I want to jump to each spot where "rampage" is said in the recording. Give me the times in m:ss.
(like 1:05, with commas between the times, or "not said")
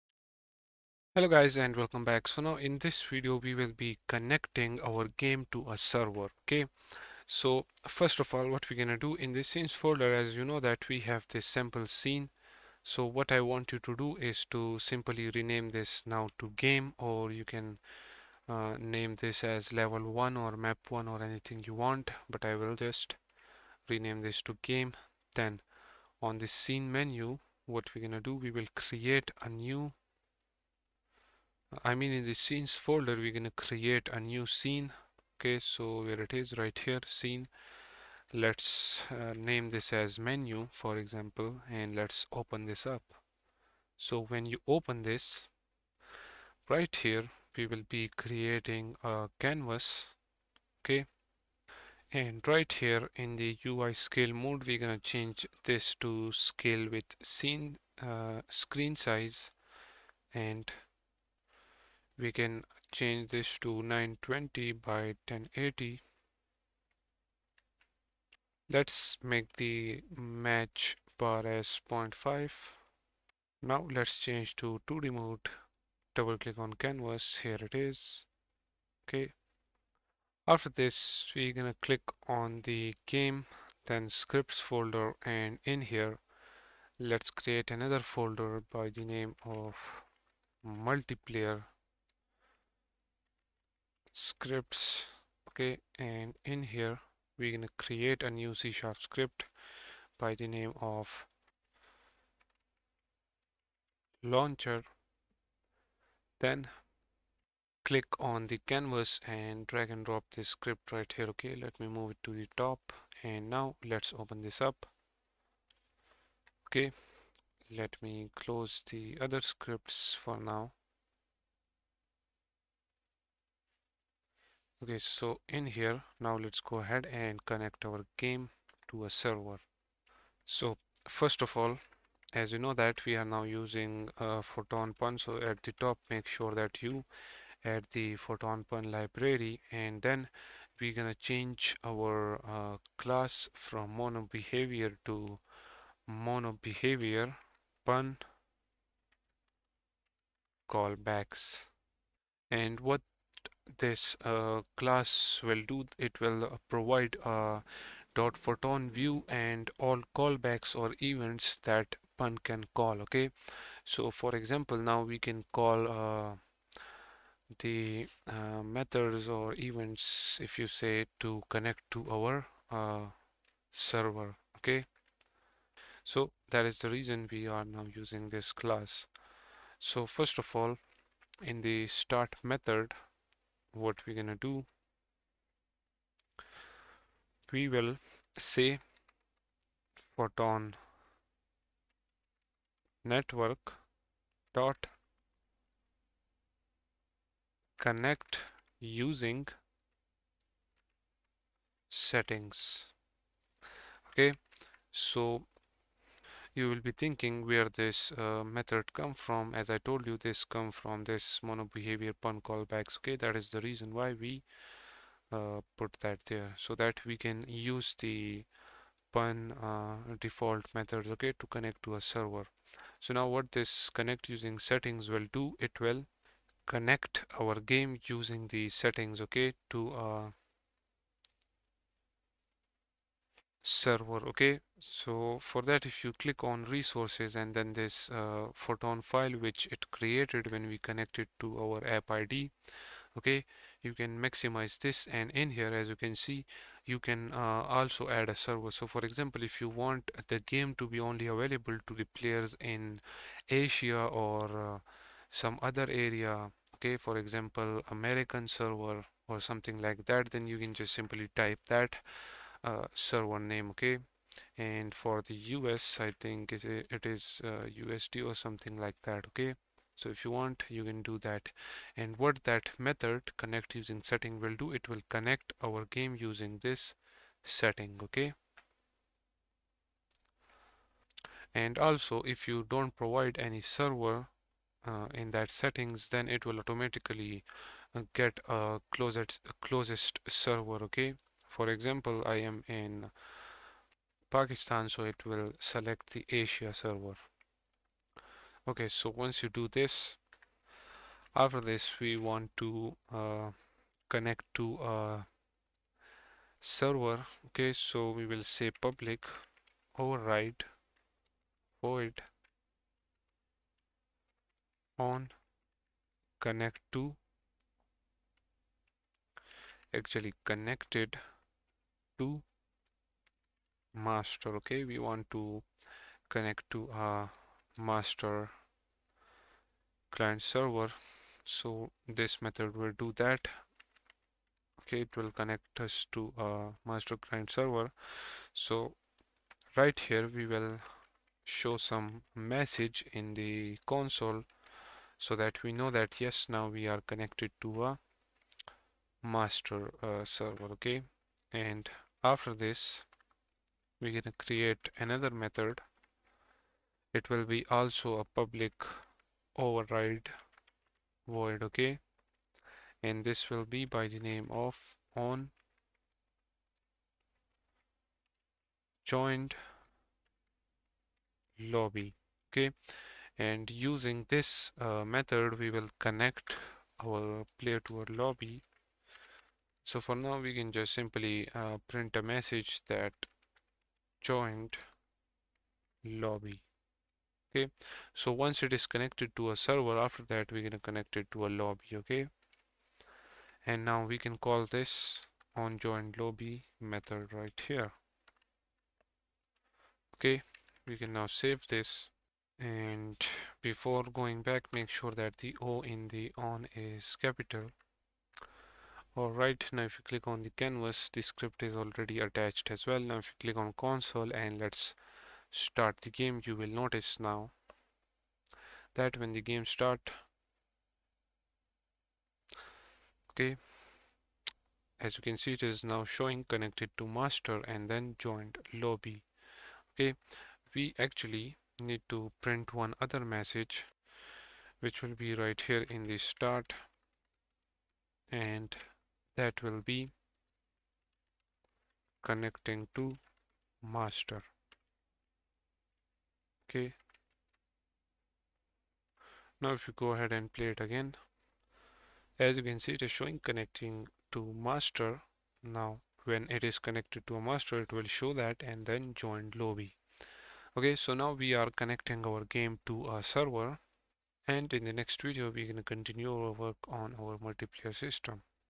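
not said.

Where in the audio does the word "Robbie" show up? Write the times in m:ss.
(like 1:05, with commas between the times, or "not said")
not said.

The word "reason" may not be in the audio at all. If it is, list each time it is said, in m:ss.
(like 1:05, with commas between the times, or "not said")
2:56, 3:33.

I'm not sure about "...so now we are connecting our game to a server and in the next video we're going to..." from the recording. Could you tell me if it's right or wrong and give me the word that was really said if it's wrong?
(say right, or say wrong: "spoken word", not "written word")
right.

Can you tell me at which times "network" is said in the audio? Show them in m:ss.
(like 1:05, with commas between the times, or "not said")
3:13.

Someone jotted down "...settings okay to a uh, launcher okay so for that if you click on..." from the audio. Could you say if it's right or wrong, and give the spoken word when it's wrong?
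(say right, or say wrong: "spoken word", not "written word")
wrong: "server", not "launcher".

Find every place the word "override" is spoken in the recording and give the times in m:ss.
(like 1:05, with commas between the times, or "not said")
5:09, 5:59.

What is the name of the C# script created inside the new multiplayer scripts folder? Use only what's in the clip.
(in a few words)
launcher.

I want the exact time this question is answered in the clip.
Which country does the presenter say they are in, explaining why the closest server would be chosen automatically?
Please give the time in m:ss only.
4:54.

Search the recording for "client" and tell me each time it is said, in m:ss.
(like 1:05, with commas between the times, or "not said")
5:30, 5:37.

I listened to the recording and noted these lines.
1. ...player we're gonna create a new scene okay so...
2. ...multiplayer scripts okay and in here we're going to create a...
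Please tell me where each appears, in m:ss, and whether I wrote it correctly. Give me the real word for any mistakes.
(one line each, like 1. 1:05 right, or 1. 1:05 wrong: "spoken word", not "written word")
1. 0:32 wrong: "folder", not "player"
2. 1:30 right.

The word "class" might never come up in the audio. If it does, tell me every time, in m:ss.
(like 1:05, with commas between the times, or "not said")
2:22, 2:34, 2:58.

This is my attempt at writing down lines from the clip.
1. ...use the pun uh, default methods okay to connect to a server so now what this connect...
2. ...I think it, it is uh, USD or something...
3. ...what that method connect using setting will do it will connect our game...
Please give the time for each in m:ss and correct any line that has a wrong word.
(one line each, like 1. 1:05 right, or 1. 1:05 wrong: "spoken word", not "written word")
1. 3:37 right
2. 4:25 right
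3. 4:32 right.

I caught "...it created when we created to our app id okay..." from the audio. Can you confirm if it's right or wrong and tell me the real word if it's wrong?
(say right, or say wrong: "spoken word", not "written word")
wrong: "connected", not "created".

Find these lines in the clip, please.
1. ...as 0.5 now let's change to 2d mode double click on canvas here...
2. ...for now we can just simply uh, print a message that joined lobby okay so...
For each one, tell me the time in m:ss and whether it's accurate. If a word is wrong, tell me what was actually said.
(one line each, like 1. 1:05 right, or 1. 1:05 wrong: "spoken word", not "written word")
1. 1:11 right
2. 6:20 right.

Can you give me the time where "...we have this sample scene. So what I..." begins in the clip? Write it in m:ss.
0:10.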